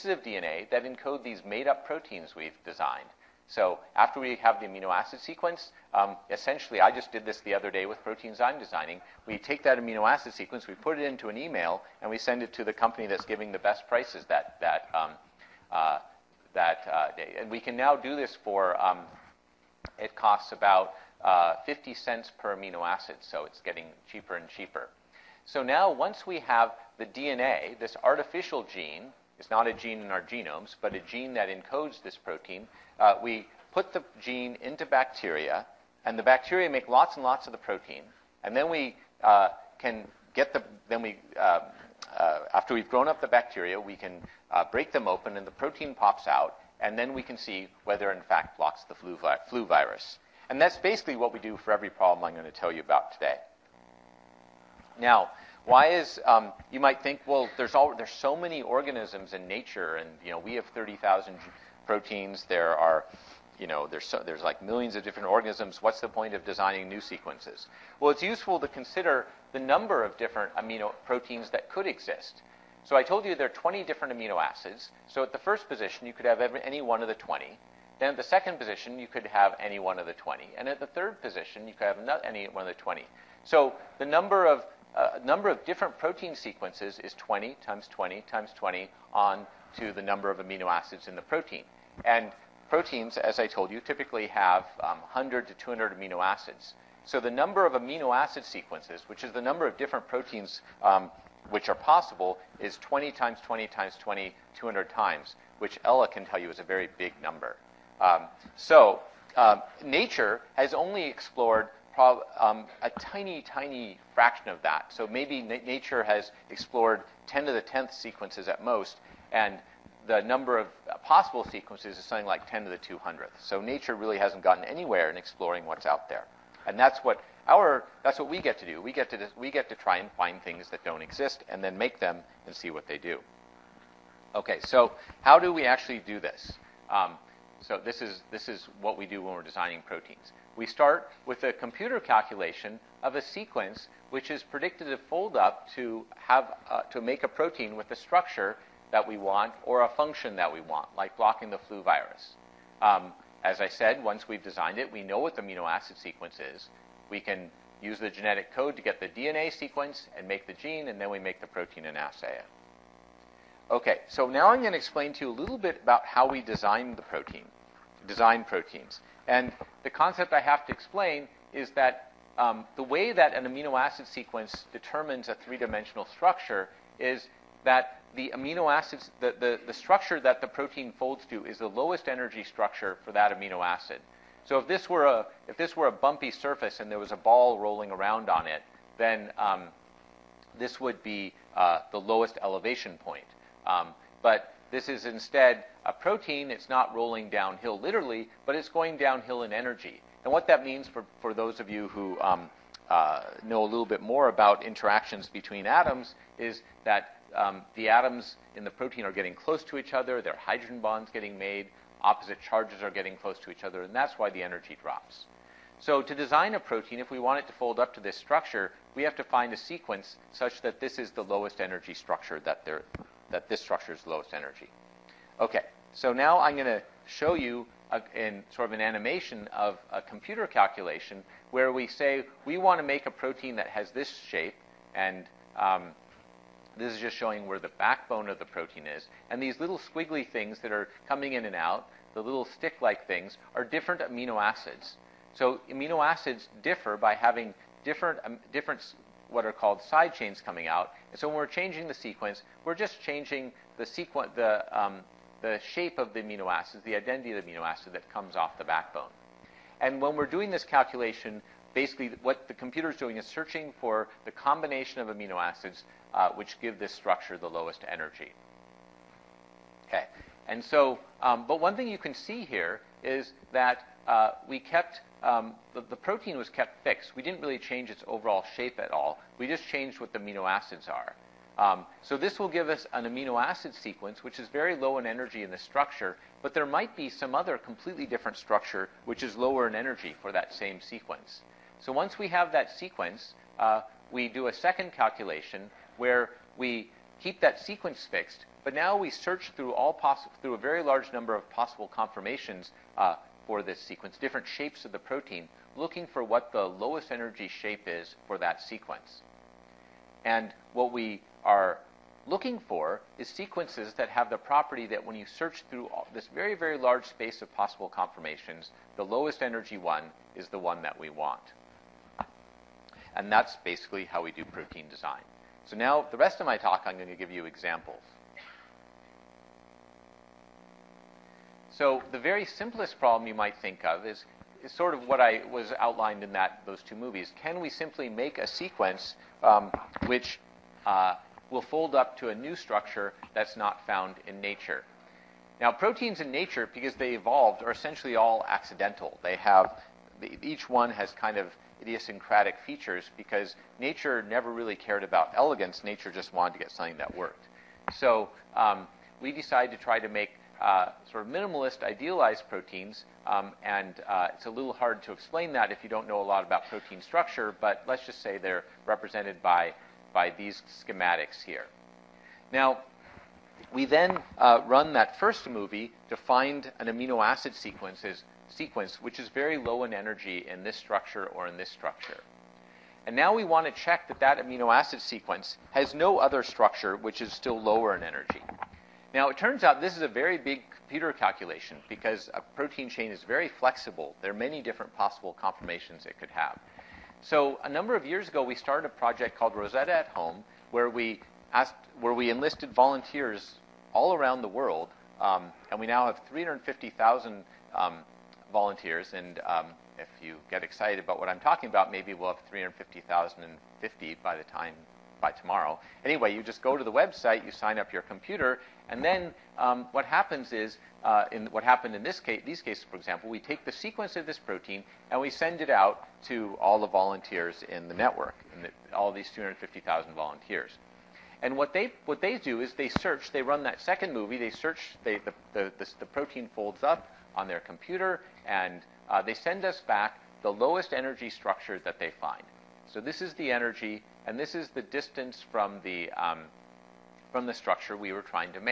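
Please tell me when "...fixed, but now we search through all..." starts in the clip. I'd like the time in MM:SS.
04:58.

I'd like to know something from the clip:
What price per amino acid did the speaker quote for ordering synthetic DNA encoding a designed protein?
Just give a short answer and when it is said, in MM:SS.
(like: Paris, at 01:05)
50 cents, at 00:21.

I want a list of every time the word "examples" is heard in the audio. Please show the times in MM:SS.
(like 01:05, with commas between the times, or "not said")
05:27, 07:02.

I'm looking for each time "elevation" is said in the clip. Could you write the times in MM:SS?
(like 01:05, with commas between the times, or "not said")
03:12.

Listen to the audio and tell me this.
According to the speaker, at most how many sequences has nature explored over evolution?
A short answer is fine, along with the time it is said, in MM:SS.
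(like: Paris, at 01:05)
10 to the 10th, at 01:57.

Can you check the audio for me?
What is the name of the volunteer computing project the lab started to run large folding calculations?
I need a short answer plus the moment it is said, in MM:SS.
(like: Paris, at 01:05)
Rosetta at Home, at 06:39.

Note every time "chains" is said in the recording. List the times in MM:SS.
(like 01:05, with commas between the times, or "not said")
04:10, 06:32.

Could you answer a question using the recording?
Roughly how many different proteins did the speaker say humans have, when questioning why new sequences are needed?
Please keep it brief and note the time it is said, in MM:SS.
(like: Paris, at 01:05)
30,000, at 01:00.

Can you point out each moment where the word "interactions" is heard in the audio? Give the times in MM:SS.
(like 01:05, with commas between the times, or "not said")
03:24.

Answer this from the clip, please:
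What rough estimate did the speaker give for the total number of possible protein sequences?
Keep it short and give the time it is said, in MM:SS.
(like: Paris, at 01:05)
10 to the 200th, at 02:02.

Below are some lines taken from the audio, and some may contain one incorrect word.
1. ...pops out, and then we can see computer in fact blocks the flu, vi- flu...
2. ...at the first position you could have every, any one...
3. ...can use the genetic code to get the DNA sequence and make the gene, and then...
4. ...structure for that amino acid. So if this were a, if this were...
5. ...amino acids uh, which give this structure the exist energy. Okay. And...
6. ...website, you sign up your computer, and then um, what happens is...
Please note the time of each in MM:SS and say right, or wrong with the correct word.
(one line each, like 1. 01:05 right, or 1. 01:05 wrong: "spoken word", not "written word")
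1. 00:45 wrong: "whether", not "computer"
2. 01:15 right
3. 02:37 right
4. 03:02 right
5. 04:25 wrong: "lowest", not "exist"
6. 06:56 right.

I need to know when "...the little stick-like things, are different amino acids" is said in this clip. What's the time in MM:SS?
04:02.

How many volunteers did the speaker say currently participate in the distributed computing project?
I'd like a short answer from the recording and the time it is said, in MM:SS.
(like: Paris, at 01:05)
350,000, at 06:46.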